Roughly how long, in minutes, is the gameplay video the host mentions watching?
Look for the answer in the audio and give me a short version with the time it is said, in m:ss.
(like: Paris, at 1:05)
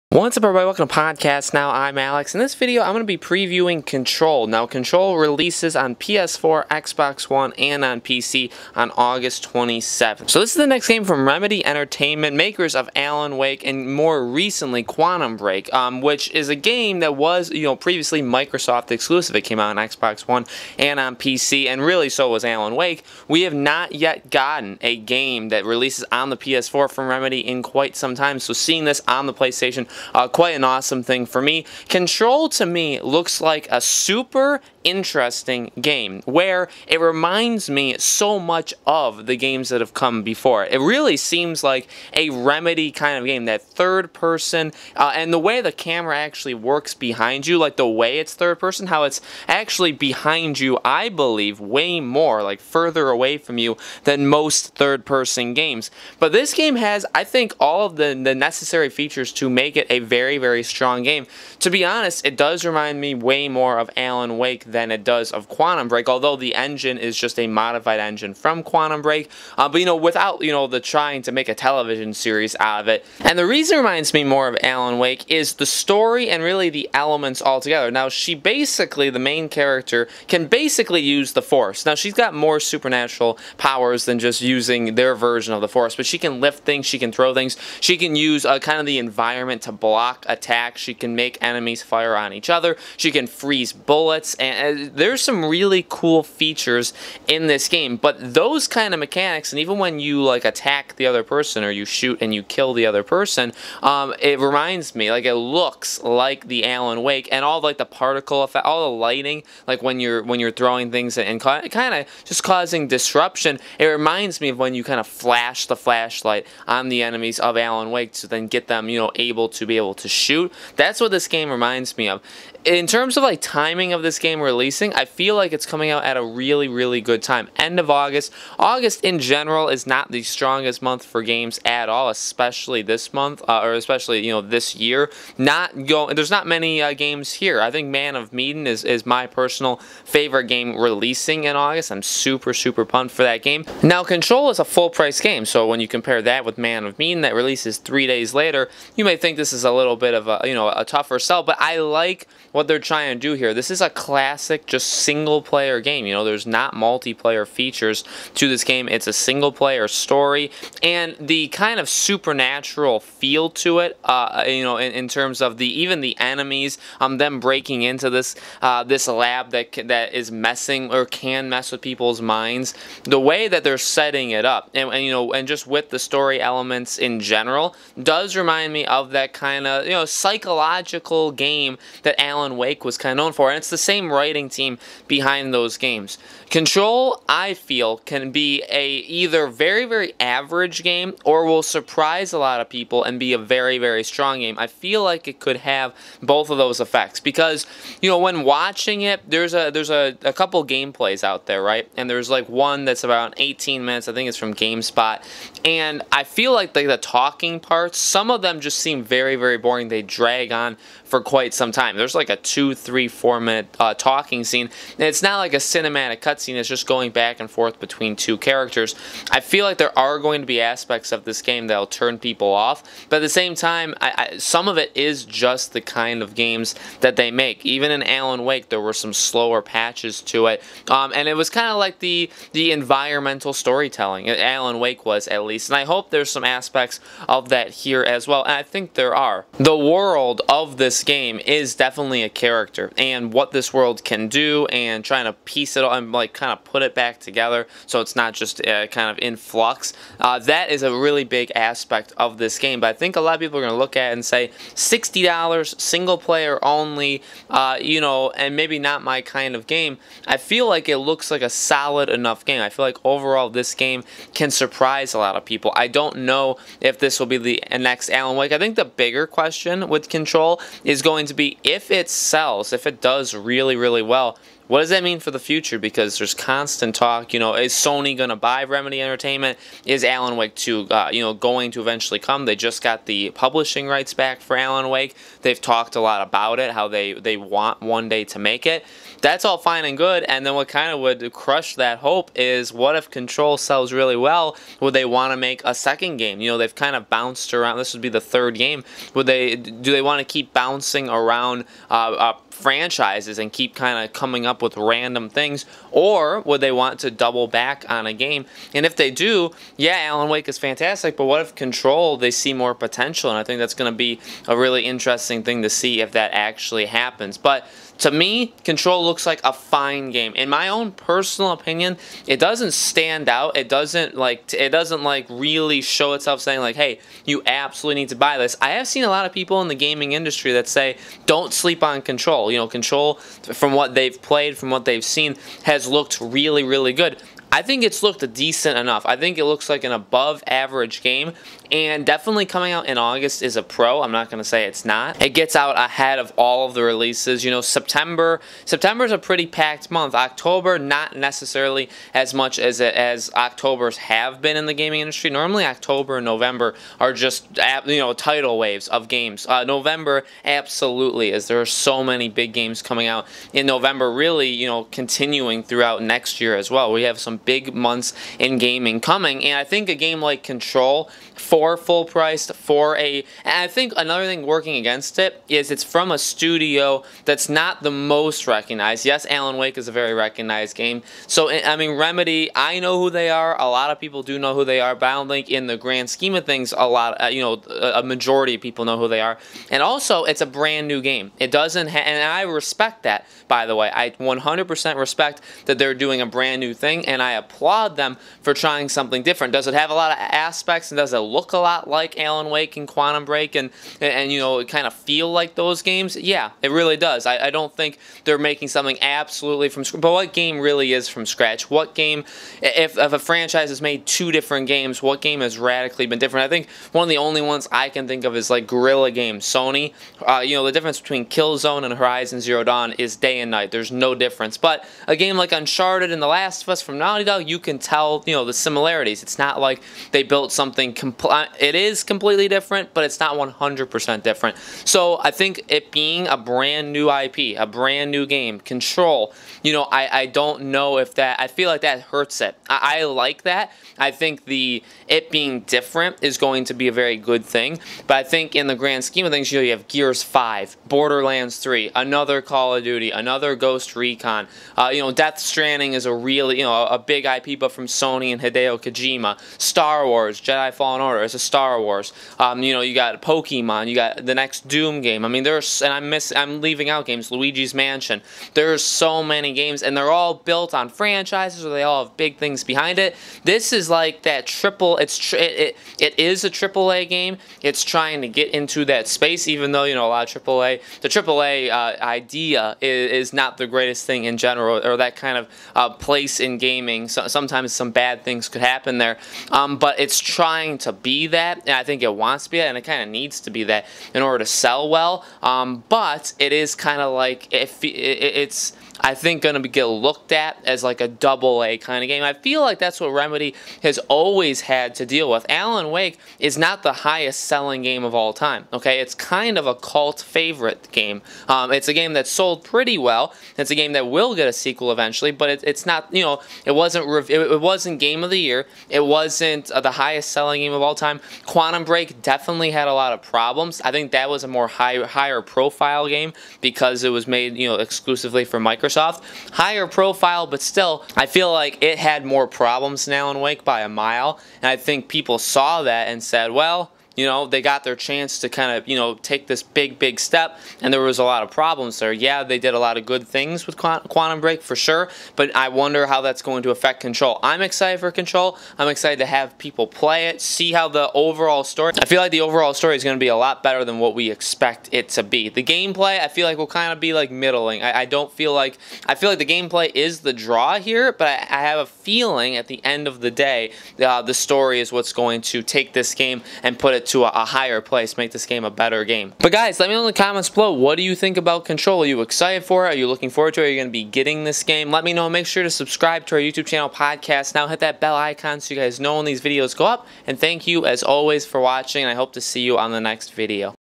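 18, at 3:23.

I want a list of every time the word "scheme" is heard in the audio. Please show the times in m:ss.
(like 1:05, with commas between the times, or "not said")
6:26, 7:29.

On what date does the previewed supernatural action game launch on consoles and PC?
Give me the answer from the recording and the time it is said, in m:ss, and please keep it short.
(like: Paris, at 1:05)
August 27th, at 0:08.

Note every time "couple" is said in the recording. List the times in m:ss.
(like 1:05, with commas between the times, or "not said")
3:20.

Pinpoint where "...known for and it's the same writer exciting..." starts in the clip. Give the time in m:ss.
3:03.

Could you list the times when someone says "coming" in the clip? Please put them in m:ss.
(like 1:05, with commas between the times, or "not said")
2:05, 5:04, 5:42, 6:02, 6:08.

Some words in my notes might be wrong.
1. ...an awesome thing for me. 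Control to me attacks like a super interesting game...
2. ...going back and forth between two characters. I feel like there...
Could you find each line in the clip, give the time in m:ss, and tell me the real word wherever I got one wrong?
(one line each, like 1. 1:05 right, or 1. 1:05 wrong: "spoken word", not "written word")
1. 0:30 wrong: "looks", not "attacks"
2. 3:36 right.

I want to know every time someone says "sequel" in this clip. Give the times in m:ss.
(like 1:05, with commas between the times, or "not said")
8:34.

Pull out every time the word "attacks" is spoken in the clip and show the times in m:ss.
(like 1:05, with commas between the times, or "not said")
1:30, 1:40.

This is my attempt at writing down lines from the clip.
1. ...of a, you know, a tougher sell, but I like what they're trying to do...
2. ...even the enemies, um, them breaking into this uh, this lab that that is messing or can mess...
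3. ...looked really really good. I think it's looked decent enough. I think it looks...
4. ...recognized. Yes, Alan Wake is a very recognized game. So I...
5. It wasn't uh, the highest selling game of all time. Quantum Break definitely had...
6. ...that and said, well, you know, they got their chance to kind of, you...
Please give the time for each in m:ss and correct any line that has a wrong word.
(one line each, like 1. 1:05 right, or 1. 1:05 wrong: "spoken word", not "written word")
1. 2:30 right
2. 2:45 right
3. 5:35 right
4. 6:18 right
5. 8:38 right
6. 8:55 right.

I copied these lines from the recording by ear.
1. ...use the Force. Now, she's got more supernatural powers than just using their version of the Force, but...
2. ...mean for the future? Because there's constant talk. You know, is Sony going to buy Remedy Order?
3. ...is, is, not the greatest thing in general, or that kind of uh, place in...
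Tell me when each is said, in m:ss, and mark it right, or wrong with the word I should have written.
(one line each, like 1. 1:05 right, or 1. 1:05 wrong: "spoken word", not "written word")
1. 1:21 right
2. 4:35 wrong: "Entertainment", not "Order"
3. 8:02 right.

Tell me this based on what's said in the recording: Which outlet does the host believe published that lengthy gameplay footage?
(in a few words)
GameSpot.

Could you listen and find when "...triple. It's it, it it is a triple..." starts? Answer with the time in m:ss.
7:54.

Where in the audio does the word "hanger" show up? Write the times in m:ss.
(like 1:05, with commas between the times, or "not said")
not said.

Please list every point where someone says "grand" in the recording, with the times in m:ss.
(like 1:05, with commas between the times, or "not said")
6:25, 7:28.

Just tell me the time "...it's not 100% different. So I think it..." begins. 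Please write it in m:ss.
7:13.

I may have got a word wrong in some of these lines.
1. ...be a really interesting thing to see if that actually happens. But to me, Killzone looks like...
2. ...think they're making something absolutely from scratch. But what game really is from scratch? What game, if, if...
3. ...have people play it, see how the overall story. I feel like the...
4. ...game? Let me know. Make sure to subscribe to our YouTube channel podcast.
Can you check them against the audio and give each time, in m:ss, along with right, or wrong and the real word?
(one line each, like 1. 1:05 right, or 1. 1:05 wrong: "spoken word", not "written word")
1. 5:13 wrong: "Control", not "Killzone"
2. 6:47 right
3. 9:09 right
4. 9:34 right.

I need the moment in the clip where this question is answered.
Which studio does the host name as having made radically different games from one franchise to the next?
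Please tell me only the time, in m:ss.
6:58.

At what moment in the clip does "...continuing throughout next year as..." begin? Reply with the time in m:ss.
6:04.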